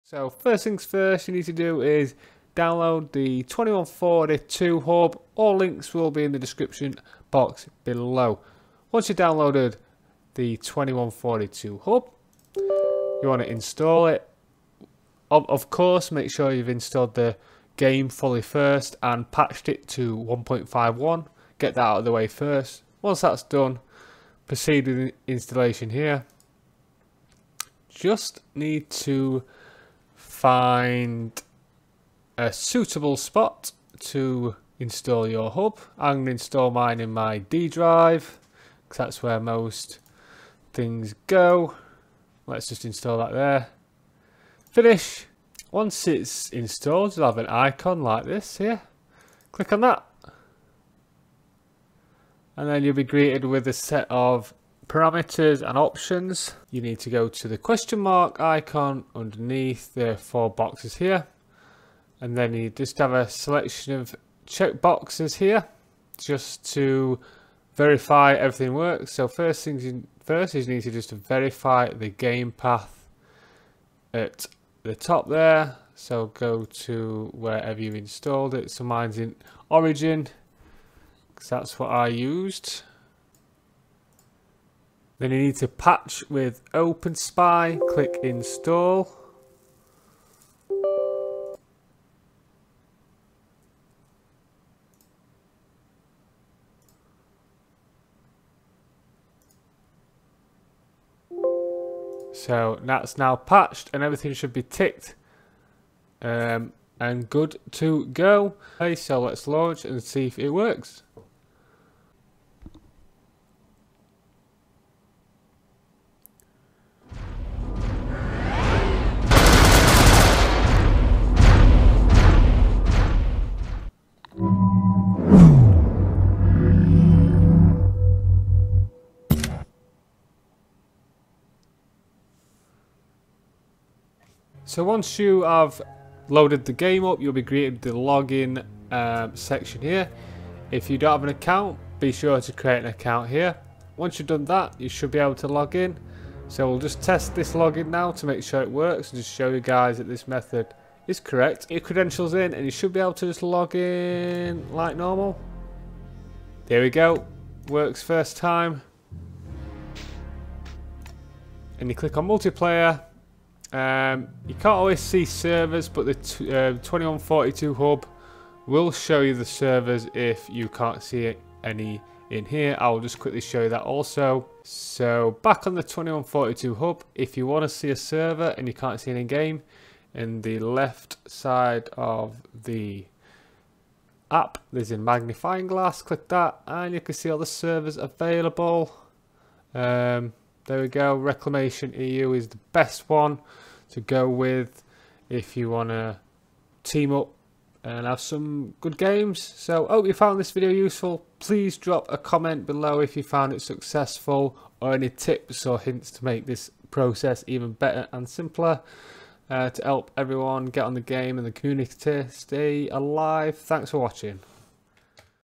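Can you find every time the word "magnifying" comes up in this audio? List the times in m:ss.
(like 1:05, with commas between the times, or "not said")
3:04.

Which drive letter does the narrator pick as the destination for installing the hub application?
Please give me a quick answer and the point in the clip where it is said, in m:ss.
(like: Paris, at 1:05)
D drive, at 0:37.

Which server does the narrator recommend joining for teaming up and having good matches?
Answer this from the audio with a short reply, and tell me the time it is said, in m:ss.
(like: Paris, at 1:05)
Reclamation EU, at 3:11.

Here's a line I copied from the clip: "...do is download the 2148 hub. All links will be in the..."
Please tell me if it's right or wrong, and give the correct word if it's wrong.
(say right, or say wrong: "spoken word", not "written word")
wrong: "2142", not "2148".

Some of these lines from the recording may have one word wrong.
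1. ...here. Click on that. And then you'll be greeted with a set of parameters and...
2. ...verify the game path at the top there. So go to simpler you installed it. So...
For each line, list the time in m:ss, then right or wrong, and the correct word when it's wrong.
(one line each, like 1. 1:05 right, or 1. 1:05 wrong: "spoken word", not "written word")
1. 0:48 right
2. 1:11 wrong: "wherever", not "simpler".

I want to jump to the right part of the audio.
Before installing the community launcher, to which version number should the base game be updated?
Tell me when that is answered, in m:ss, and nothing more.
0:20.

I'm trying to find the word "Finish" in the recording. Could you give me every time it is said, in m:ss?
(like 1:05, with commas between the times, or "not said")
0:44.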